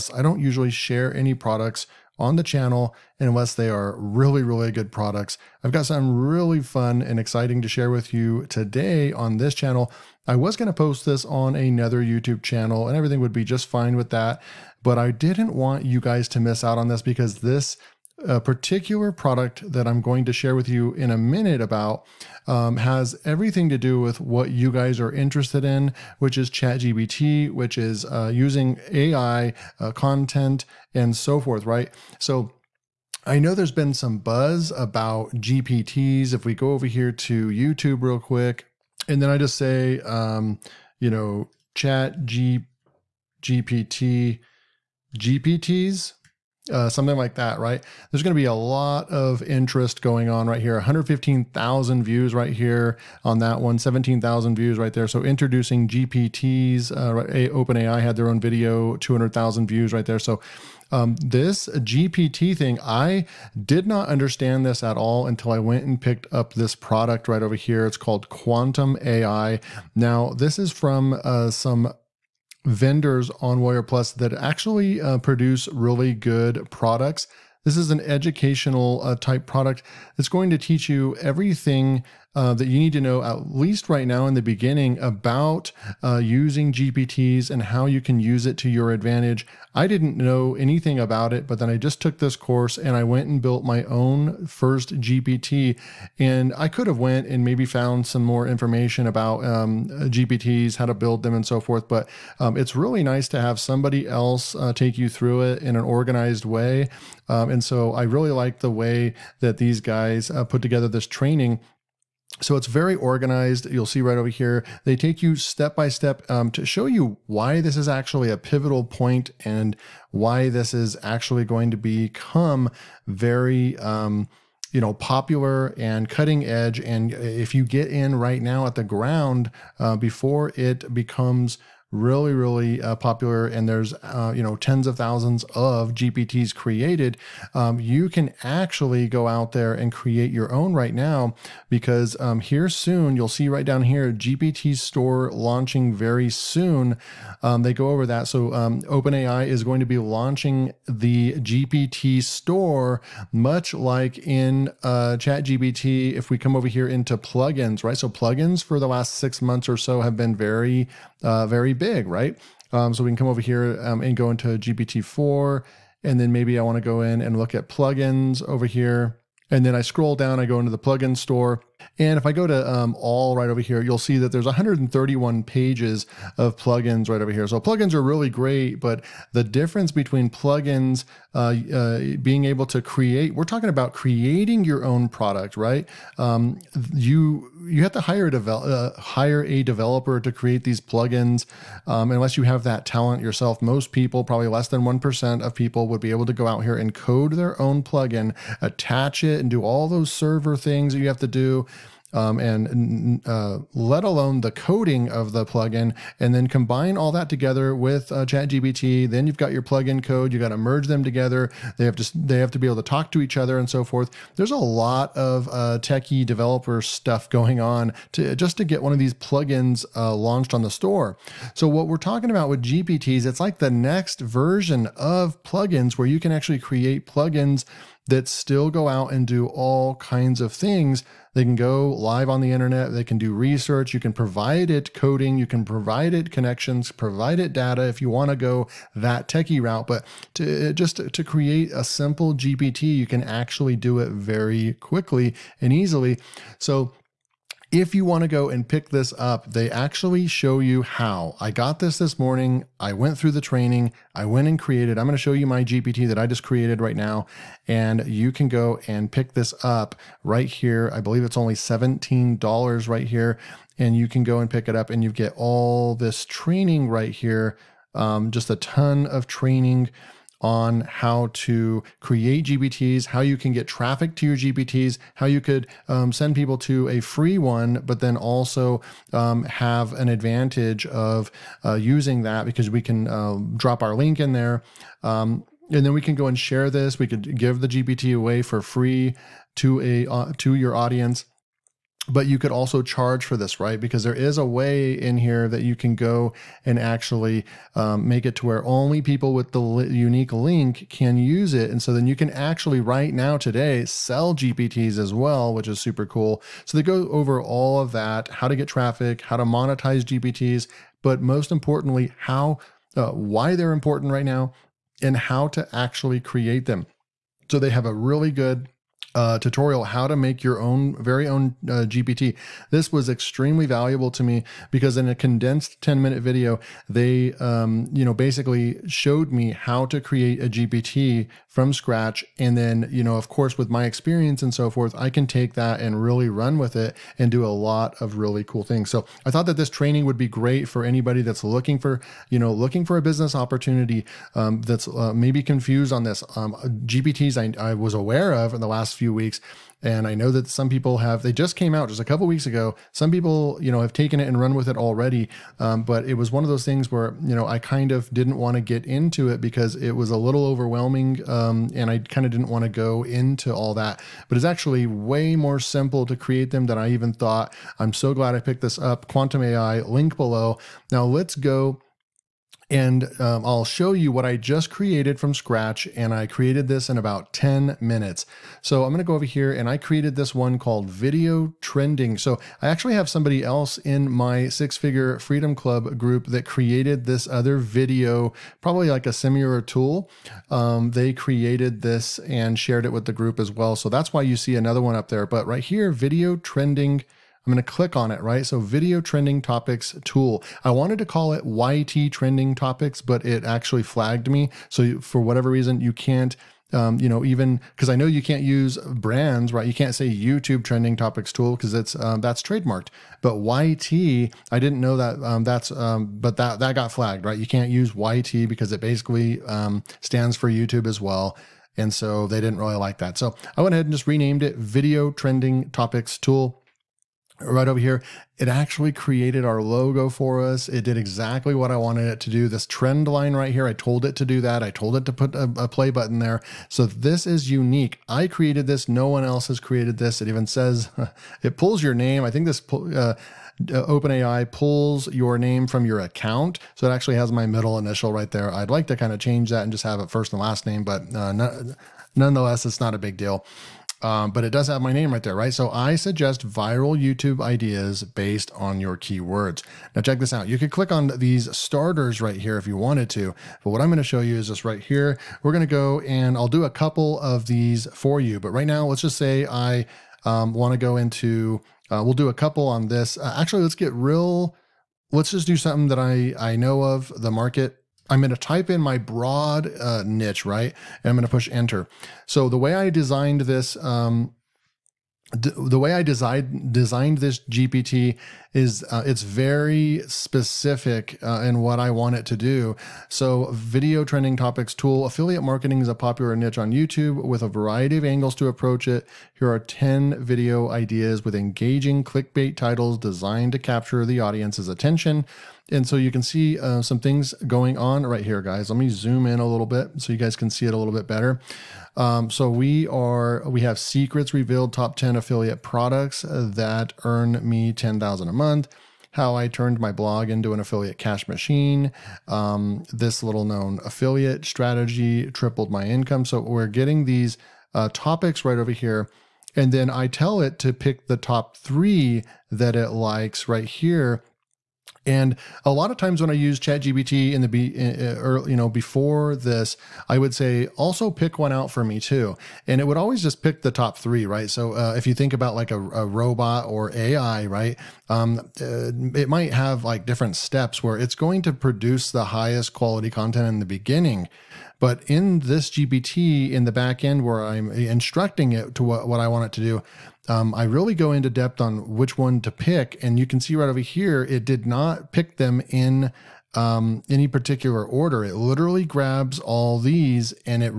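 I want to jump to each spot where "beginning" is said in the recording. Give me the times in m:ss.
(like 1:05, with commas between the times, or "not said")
1:24, 9:13.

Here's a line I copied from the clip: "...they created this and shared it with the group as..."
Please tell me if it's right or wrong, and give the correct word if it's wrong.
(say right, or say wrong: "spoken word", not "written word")
right.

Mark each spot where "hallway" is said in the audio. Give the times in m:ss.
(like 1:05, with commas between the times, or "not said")
not said.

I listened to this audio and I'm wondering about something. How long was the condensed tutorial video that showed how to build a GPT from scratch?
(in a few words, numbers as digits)
10 minutes.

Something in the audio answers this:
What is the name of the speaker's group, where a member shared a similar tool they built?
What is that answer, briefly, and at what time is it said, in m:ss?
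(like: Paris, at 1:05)
six figure freedom club, at 6:24.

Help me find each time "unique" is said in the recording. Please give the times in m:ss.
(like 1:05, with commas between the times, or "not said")
4:59, 7:17.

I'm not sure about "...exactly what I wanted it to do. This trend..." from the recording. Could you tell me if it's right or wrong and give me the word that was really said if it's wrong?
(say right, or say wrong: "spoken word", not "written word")
right.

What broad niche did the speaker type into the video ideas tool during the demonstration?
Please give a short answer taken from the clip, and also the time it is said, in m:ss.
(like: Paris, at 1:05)
affiliate marketing, at 8:15.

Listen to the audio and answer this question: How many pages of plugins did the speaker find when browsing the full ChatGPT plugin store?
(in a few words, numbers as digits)
131.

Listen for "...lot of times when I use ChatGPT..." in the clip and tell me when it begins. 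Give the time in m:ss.
8:55.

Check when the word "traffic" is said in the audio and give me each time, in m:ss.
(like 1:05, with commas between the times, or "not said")
4:33, 5:08.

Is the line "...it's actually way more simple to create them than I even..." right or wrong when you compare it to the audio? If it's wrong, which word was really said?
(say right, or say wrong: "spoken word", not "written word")
right.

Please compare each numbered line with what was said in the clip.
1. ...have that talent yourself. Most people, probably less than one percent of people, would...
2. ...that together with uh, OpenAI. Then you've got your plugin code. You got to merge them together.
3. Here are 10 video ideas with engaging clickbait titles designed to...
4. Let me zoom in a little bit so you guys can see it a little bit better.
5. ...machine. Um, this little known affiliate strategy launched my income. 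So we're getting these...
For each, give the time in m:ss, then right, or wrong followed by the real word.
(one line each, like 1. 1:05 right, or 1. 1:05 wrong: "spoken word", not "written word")
1. 3:12 right
2. 3:27 wrong: "ChatGPT", not "OpenAI"
3. 8:19 right
4. 8:28 right
5. 8:41 wrong: "tripled", not "launched".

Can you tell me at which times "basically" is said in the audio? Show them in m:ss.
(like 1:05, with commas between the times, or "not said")
5:28, 6:58.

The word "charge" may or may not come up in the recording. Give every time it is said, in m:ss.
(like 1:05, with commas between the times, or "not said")
4:52.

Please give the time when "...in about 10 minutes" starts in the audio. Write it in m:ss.
6:16.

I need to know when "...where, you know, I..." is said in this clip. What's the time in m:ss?
5:56.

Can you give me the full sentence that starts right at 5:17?
So they have a really good uh, tutorial how to make your own very own uh, GPT.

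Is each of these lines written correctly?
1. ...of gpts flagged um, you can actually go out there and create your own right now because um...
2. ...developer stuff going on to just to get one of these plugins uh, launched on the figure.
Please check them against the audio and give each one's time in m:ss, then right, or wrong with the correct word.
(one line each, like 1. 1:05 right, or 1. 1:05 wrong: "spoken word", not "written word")
1. 2:15 wrong: "created", not "flagged"
2. 3:36 wrong: "store", not "figure".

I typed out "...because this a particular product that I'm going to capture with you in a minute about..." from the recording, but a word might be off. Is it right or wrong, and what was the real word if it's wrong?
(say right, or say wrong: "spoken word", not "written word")
wrong: "share", not "capture".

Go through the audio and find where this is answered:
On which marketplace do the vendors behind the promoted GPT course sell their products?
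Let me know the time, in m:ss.
1:13.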